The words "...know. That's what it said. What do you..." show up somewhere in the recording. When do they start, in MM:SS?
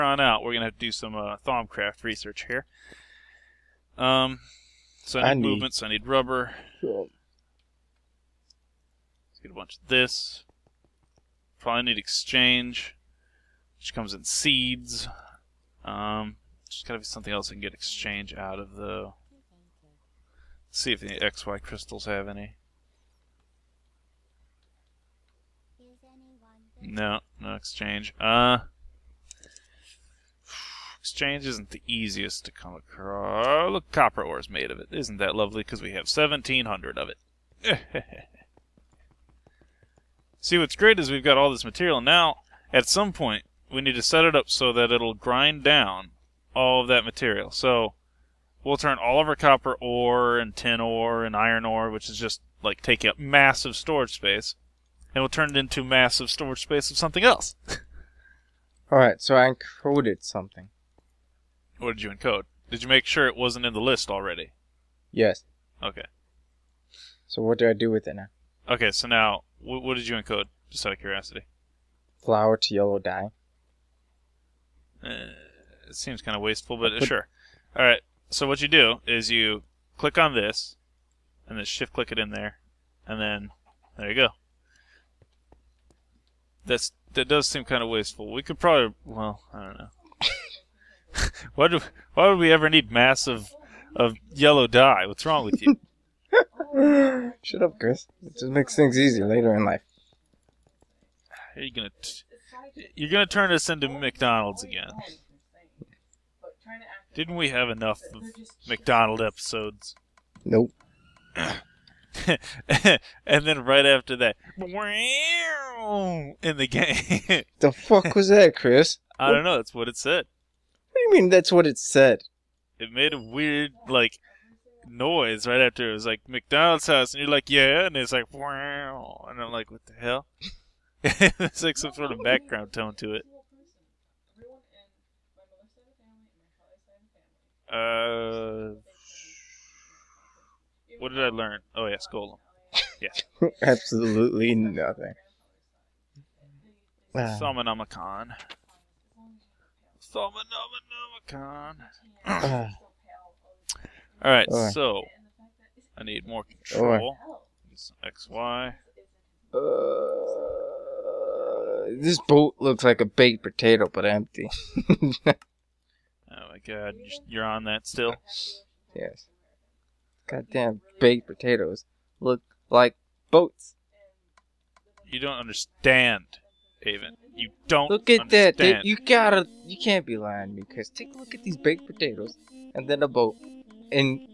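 01:59.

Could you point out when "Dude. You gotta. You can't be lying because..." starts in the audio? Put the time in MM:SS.
02:58.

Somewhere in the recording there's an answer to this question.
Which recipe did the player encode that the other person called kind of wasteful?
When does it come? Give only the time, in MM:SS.
01:12.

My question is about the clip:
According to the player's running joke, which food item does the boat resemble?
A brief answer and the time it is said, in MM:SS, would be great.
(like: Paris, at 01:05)
Baked potato, at 02:43.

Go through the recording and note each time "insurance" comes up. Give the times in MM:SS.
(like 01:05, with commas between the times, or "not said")
not said.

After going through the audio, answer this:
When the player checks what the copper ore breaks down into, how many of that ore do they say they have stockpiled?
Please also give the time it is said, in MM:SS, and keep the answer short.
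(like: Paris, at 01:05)
1,700, at 00:36.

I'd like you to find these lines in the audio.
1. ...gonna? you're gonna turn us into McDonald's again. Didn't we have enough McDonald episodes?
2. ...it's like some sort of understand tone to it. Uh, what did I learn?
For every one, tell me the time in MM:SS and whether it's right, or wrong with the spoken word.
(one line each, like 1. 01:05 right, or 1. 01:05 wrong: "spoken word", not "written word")
1. 01:41 right
2. 02:11 wrong: "background", not "understand".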